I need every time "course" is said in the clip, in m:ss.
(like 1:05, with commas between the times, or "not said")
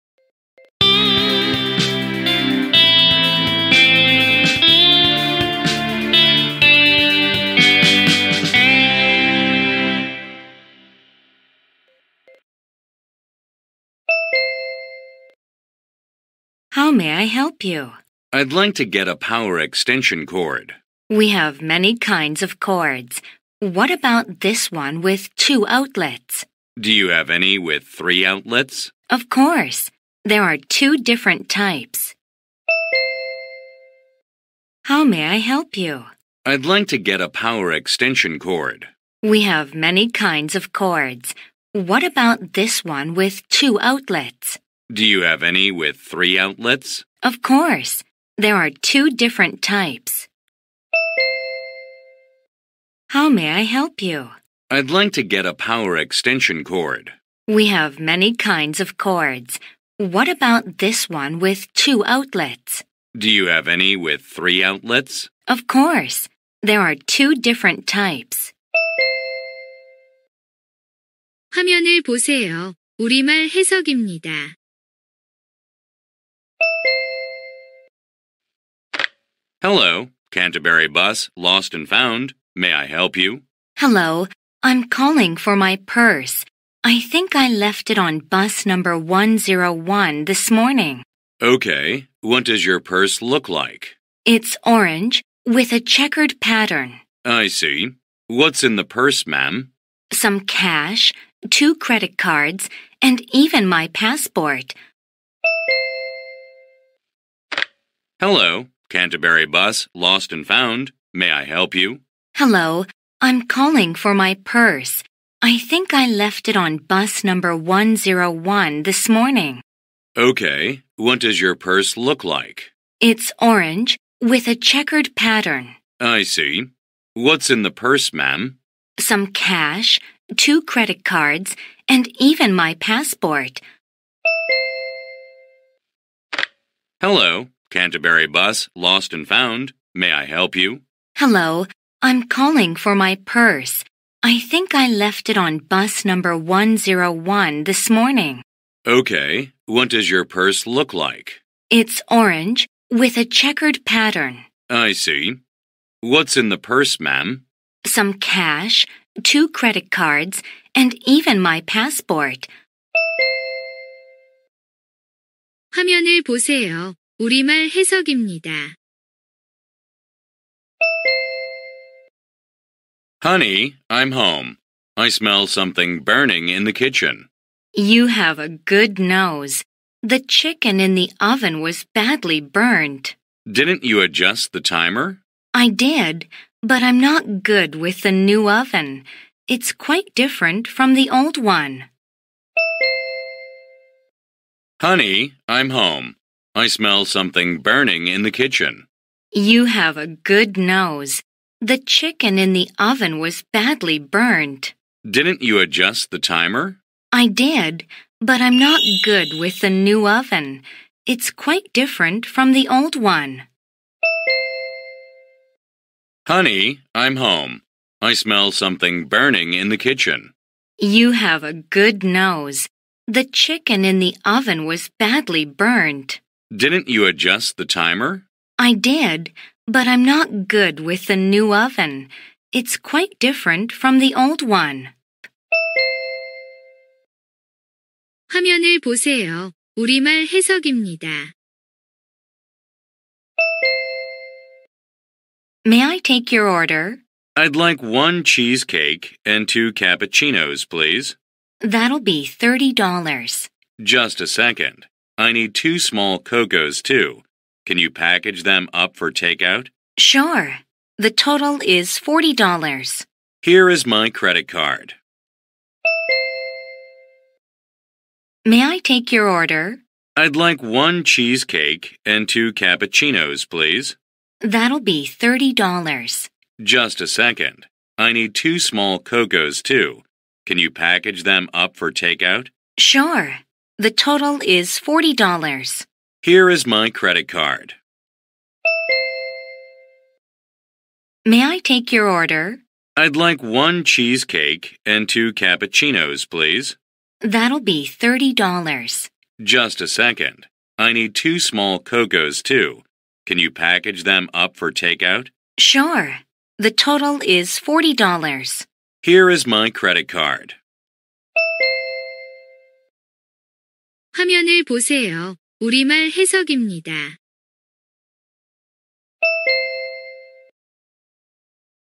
0:29, 0:47, 1:05.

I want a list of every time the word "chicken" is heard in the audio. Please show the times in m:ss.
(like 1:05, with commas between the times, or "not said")
3:00, 3:21, 3:43.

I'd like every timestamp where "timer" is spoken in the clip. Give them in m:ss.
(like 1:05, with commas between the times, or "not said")
3:04, 3:26, 3:47.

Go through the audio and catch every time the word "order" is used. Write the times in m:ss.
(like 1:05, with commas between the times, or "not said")
4:06, 4:29, 4:52.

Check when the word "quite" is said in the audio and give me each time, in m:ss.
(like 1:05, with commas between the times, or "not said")
3:09, 3:31, 3:52.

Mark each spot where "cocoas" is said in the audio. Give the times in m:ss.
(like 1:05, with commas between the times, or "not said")
4:16, 4:38, 5:01.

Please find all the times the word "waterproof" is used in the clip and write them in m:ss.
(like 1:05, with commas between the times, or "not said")
not said.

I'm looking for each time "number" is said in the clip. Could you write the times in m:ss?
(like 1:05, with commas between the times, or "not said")
1:28, 1:57, 2:26.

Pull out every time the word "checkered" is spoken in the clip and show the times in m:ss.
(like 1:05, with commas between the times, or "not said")
1:35, 2:04, 2:33.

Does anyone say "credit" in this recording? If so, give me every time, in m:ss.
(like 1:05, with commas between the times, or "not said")
1:41, 2:10, 2:39, 4:24, 4:46, 5:09.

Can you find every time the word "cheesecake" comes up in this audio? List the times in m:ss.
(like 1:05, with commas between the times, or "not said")
4:08, 4:31, 4:53.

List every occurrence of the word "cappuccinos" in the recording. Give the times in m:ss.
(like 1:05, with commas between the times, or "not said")
4:09, 4:32, 4:55.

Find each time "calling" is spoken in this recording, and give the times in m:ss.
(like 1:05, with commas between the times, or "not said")
1:24, 1:53, 2:22.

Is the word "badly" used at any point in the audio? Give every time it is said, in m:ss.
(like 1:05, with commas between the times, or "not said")
3:01, 3:23, 3:44.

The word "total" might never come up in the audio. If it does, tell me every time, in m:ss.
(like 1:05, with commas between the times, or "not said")
4:21, 4:43, 5:06.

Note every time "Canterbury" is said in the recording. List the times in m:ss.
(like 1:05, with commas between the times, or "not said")
1:20, 1:48, 2:17.